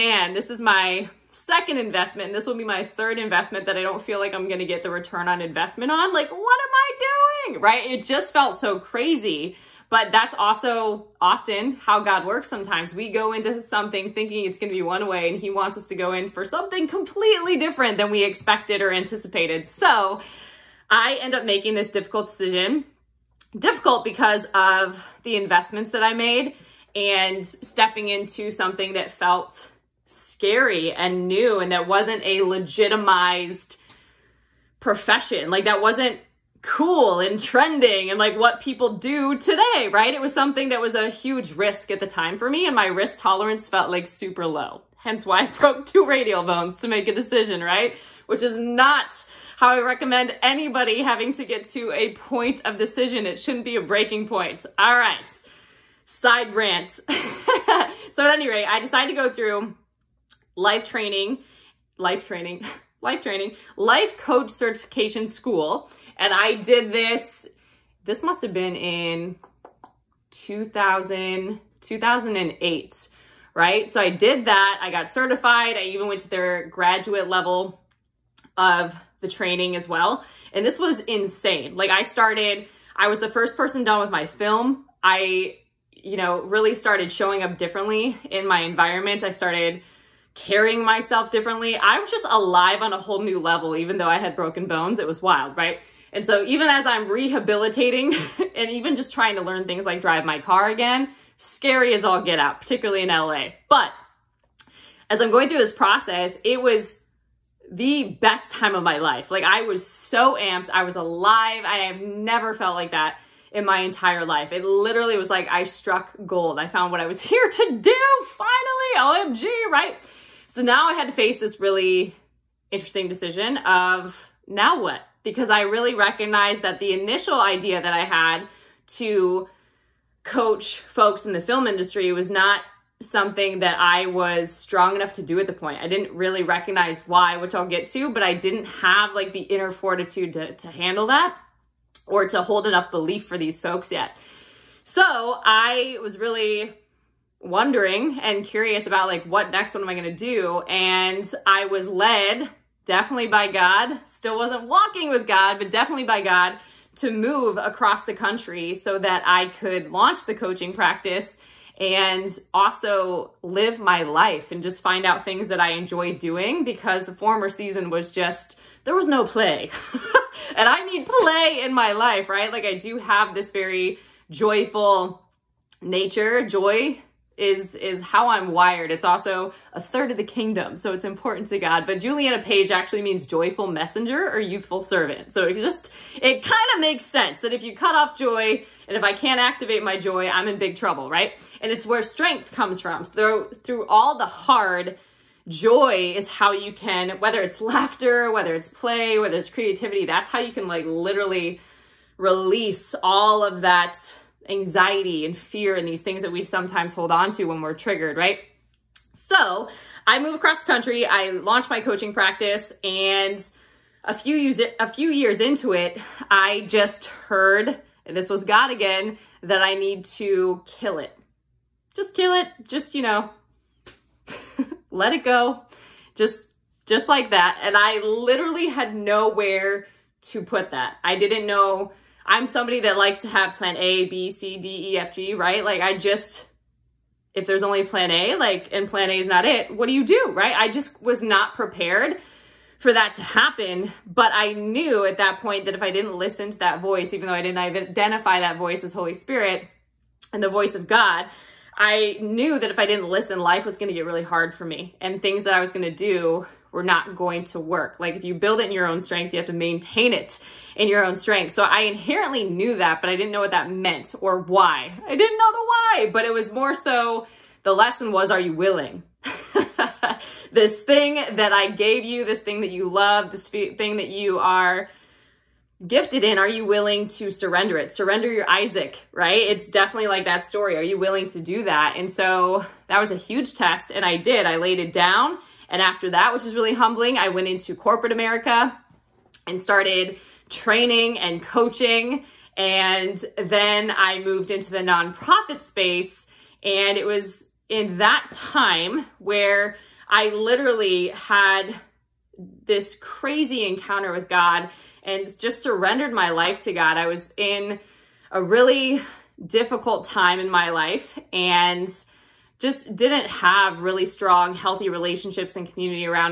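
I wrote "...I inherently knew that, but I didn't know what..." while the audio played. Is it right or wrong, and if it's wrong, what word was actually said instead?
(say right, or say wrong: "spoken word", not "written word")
right.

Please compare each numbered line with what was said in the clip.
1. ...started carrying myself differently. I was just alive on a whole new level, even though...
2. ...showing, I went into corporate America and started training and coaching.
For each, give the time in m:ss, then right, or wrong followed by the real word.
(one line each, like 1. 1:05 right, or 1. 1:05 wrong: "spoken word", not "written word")
1. 1:29 right
2. 4:46 wrong: "humbling", not "showing".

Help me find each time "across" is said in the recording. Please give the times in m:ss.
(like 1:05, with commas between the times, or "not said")
2:37, 3:30.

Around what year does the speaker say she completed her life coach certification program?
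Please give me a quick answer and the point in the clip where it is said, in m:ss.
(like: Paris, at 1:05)
2008, at 1:11.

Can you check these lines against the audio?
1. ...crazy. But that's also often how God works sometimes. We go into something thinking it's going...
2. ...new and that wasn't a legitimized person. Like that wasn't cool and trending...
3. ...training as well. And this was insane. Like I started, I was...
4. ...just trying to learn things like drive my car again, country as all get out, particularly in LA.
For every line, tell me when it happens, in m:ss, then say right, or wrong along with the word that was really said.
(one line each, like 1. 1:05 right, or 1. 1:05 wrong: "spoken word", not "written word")
1. 0:08 right
2. 0:31 wrong: "profession", not "person"
3. 1:19 right
4. 1:38 wrong: "scary", not "country".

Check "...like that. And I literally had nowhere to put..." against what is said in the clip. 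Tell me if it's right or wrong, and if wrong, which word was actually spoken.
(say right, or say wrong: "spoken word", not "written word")
right.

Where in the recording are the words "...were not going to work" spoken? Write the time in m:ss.
4:16.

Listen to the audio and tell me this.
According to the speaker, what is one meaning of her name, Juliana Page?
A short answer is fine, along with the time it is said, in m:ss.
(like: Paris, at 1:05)
joyful messenger, at 3:03.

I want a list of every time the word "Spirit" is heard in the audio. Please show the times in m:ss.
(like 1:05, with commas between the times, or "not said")
4:09.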